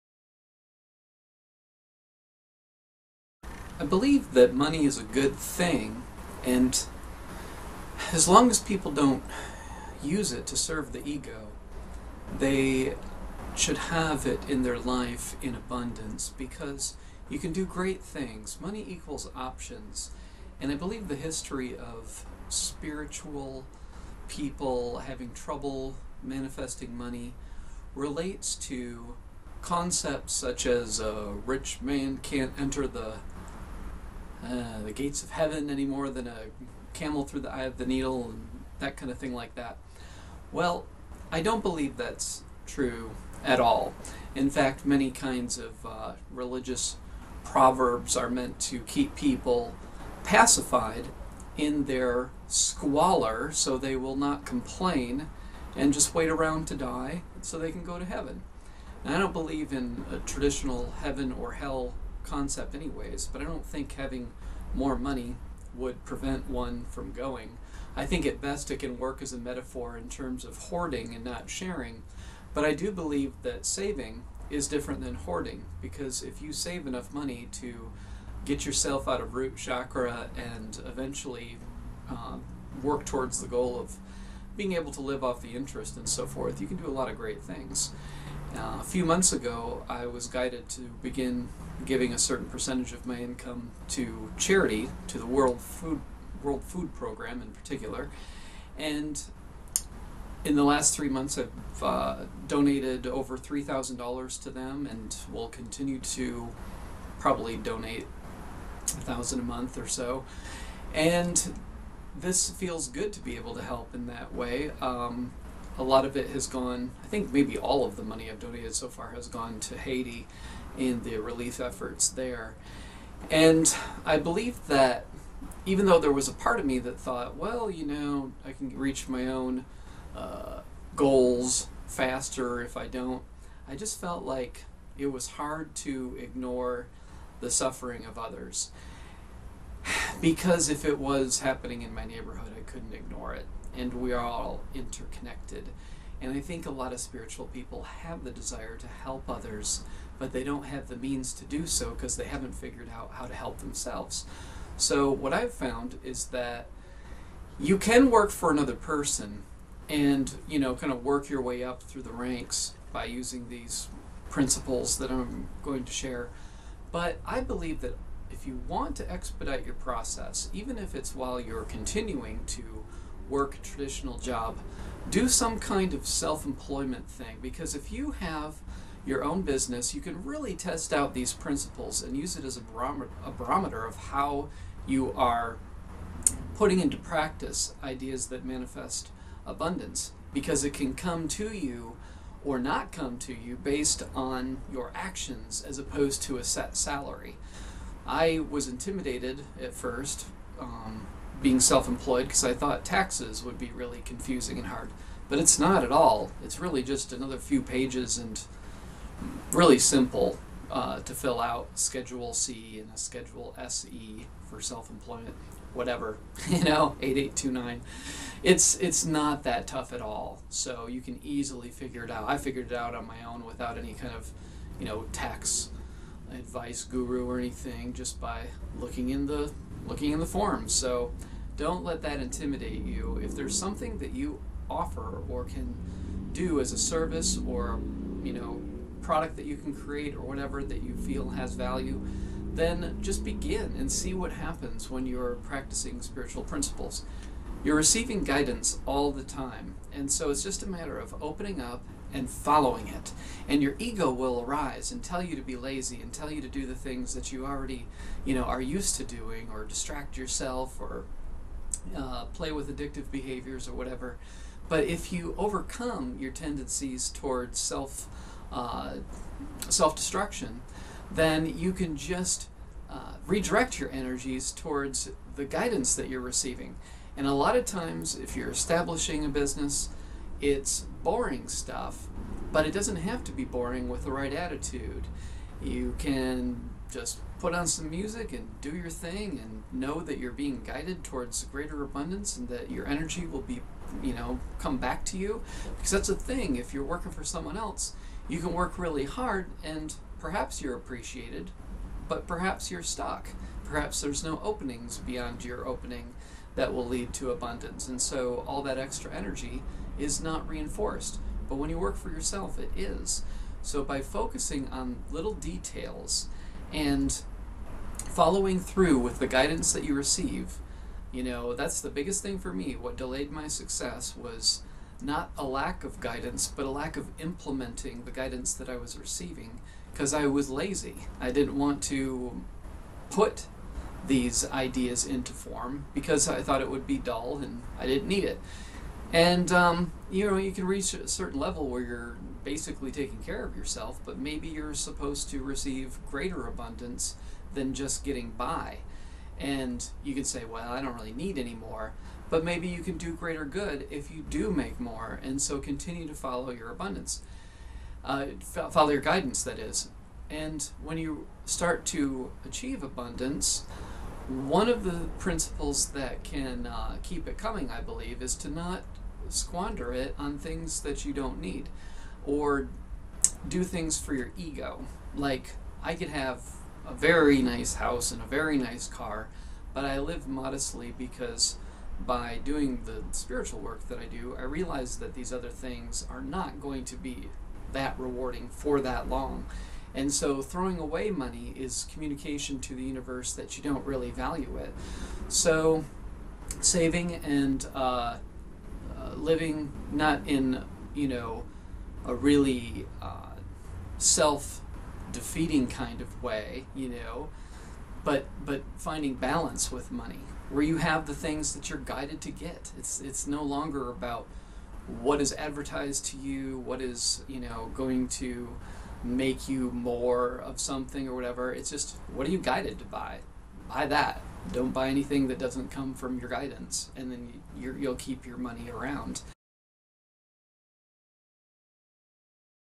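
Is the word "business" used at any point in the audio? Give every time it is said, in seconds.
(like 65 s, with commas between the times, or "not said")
179 s, 279 s.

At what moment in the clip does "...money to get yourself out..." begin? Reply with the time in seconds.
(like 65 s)
77 s.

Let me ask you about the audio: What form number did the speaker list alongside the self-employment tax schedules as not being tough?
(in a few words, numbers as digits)
8829.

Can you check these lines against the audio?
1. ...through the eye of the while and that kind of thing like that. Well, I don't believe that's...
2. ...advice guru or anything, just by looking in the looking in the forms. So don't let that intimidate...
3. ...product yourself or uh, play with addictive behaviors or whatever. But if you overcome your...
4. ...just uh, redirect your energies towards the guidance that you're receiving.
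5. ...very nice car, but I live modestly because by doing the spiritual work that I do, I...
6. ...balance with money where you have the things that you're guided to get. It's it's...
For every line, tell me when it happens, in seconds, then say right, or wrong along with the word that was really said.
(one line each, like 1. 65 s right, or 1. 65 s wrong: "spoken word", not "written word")
1. 37 s wrong: "needle", not "while"
2. 226 s right
3. 259 s wrong: "distract", not "product"
4. 271 s right
5. 378 s right
6. 409 s right.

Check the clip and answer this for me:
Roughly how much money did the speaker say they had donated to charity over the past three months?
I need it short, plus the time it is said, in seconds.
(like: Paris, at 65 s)
$3,000, at 103 s.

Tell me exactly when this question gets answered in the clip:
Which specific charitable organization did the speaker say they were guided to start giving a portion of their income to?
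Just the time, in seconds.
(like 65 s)
96 s.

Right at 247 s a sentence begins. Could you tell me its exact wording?
You're receiving guidance all the time.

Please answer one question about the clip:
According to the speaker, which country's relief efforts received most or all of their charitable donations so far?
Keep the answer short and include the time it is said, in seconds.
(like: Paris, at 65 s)
Haiti, at 119 s.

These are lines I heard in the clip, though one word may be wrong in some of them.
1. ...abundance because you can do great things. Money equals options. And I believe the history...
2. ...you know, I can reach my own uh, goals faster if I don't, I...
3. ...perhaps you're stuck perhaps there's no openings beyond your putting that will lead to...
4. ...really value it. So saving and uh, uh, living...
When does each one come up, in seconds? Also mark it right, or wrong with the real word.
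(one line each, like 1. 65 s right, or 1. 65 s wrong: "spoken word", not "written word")
1. 15 s right
2. 127 s right
3. 302 s wrong: "opening", not "putting"
4. 393 s right.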